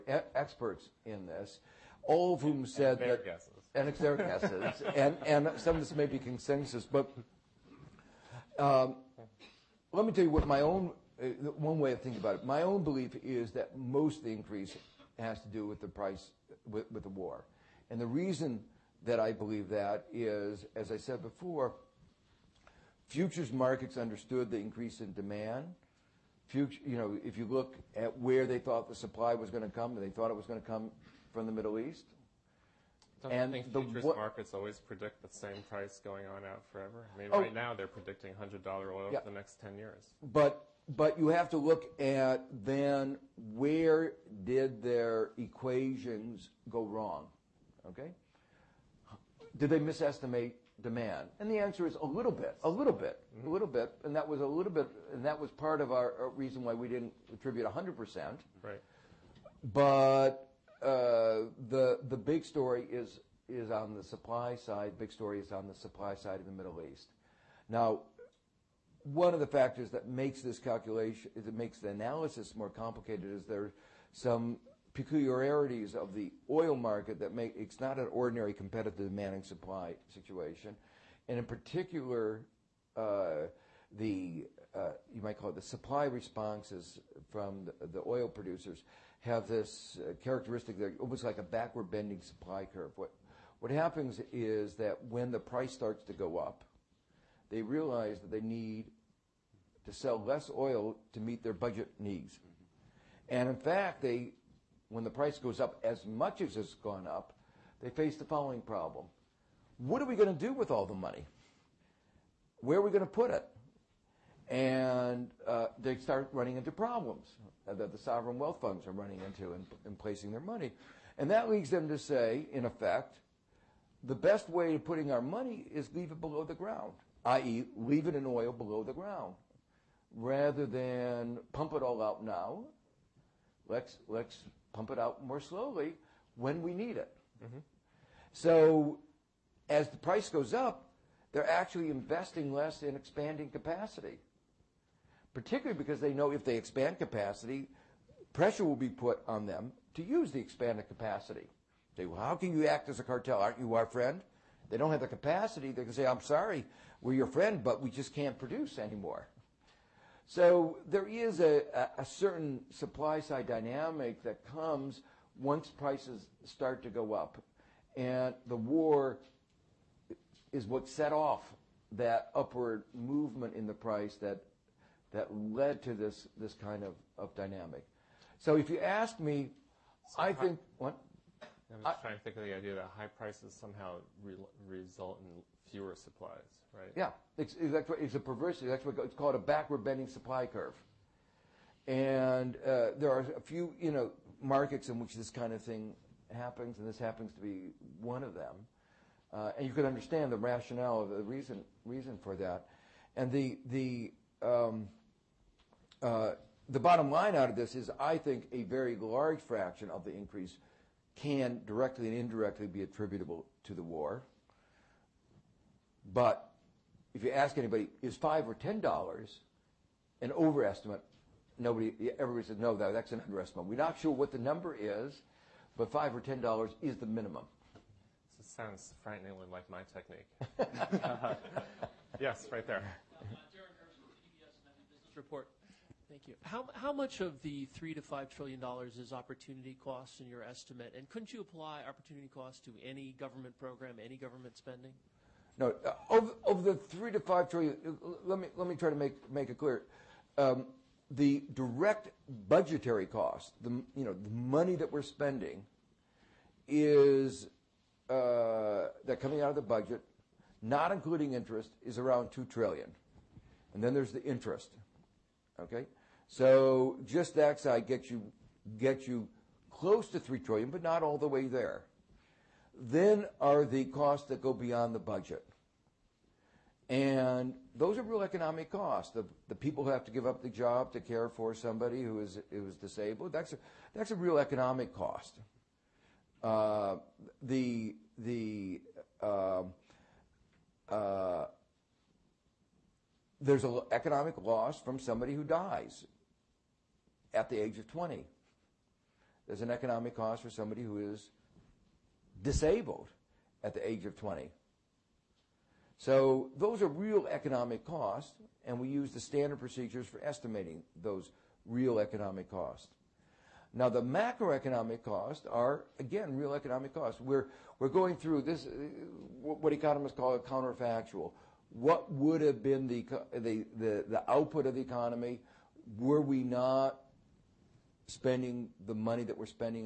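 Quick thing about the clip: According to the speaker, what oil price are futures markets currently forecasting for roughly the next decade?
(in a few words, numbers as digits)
$100.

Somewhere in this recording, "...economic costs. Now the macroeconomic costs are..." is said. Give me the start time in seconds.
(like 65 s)
311 s.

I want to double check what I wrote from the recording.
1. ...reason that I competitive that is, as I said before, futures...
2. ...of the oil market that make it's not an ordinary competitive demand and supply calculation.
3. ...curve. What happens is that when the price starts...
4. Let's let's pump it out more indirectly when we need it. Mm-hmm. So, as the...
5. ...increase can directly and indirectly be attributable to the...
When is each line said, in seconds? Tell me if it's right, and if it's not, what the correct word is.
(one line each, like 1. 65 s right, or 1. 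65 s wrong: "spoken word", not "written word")
1. 18 s wrong: "believe", not "competitive"
2. 75 s wrong: "situation", not "calculation"
3. 92 s right
4. 133 s wrong: "slowly", not "indirectly"
5. 210 s right.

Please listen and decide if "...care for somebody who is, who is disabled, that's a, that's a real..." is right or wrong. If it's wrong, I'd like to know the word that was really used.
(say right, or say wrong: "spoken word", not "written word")
right.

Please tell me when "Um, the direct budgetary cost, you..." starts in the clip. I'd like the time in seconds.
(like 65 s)
250 s.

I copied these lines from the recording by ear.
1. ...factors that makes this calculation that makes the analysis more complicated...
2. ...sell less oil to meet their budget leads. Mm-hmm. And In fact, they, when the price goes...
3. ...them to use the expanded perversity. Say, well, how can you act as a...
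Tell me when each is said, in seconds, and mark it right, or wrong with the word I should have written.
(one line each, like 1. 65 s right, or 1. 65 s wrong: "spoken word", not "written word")
1. 69 s right
2. 99 s wrong: "needs", not "leads"
3. 149 s wrong: "capacity", not "perversity".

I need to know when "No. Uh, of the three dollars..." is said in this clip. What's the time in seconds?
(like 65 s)
245 s.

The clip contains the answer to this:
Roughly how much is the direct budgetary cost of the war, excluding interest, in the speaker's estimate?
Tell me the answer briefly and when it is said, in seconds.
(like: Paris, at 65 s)
$2 trillion, at 262 s.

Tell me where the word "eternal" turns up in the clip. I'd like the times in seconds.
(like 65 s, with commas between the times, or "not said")
not said.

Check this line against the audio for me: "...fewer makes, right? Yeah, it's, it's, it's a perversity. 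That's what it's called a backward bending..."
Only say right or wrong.
wrong.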